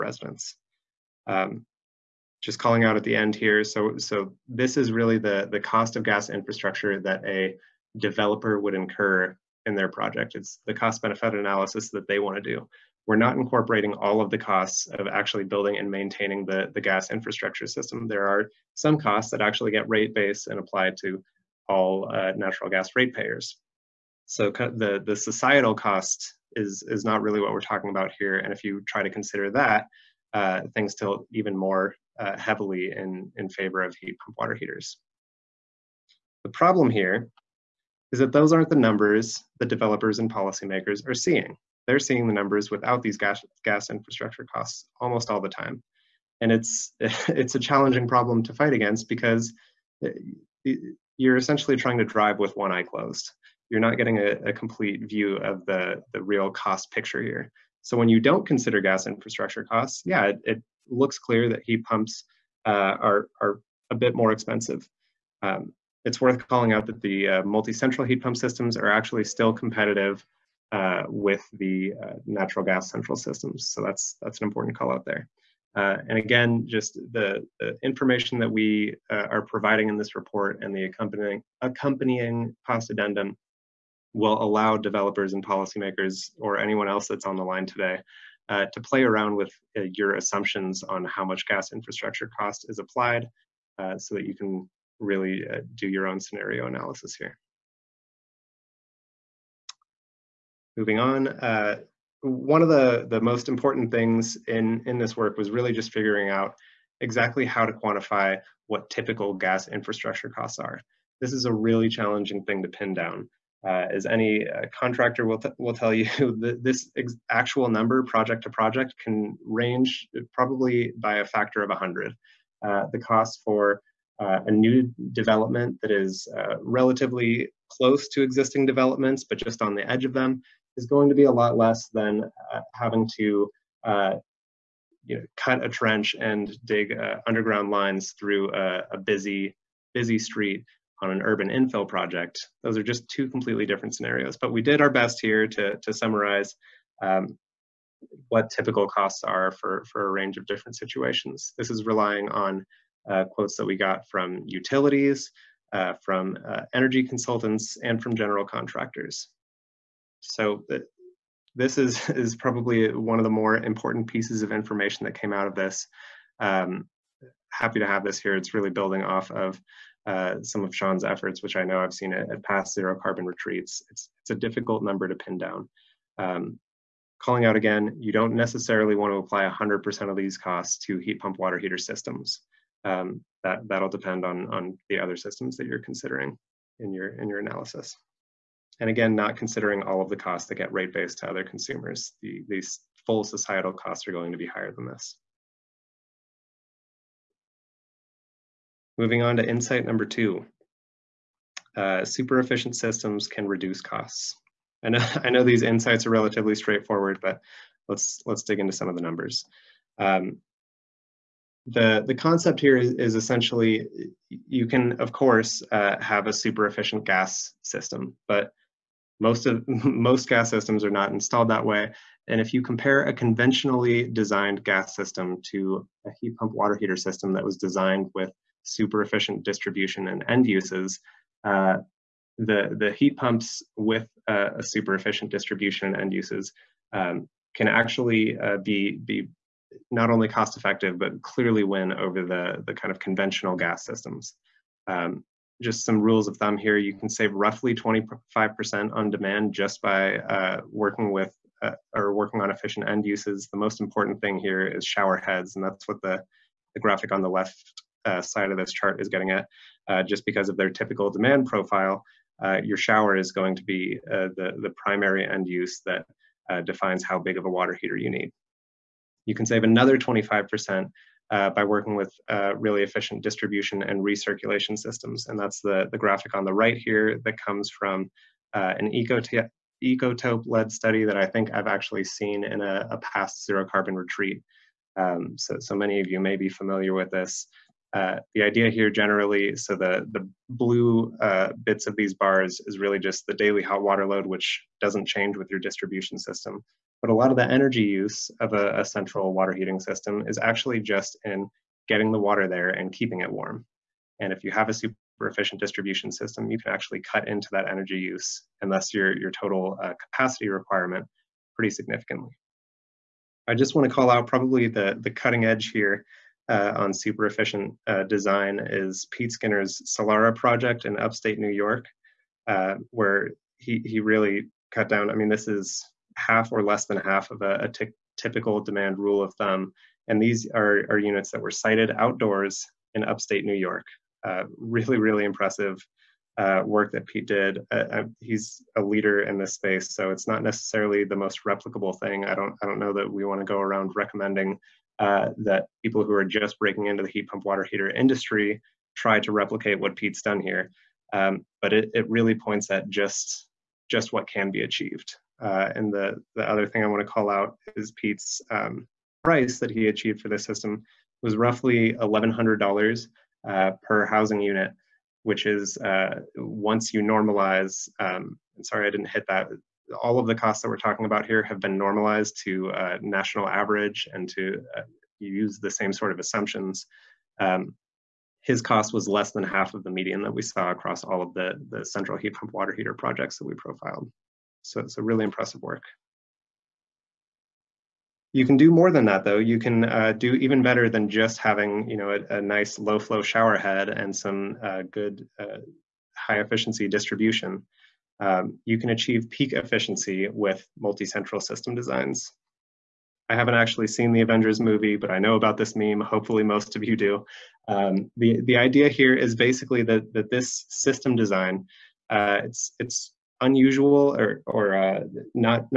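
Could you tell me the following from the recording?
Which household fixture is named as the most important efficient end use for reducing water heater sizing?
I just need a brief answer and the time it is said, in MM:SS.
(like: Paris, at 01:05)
Shower heads, at 04:14.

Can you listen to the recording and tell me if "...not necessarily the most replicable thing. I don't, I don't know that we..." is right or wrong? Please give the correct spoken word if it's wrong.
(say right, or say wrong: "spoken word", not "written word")
right.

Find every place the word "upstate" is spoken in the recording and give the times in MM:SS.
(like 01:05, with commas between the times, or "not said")
05:20, 05:33.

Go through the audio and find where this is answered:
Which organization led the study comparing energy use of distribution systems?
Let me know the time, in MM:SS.
04:38.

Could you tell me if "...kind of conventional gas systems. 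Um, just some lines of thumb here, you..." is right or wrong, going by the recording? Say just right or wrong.
wrong.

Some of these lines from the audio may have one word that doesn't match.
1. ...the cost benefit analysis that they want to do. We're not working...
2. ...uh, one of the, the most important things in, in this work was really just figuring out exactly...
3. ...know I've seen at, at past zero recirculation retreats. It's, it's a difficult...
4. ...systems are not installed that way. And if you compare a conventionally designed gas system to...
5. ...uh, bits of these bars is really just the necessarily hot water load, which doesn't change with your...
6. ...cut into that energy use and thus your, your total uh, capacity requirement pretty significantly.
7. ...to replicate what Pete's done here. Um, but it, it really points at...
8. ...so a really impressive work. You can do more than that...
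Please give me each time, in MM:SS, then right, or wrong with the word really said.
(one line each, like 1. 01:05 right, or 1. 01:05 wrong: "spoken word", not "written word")
1. 00:10 wrong: "incorporating", not "working"
2. 01:41 right
3. 02:51 wrong: "carbon", not "recirculation"
4. 03:40 right
5. 04:51 wrong: "daily", not "necessarily"
6. 05:07 right
7. 05:49 right
8. 06:24 right.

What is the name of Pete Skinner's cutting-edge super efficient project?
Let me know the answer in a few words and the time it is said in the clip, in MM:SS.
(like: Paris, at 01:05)
Solara, at 05:19.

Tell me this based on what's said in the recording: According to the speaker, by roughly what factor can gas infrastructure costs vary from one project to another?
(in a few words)
100.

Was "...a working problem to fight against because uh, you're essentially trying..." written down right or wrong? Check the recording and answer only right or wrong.
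wrong.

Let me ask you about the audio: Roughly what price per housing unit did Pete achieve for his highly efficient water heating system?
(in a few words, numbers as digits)
$1,100.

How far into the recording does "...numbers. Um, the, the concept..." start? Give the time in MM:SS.
03:29.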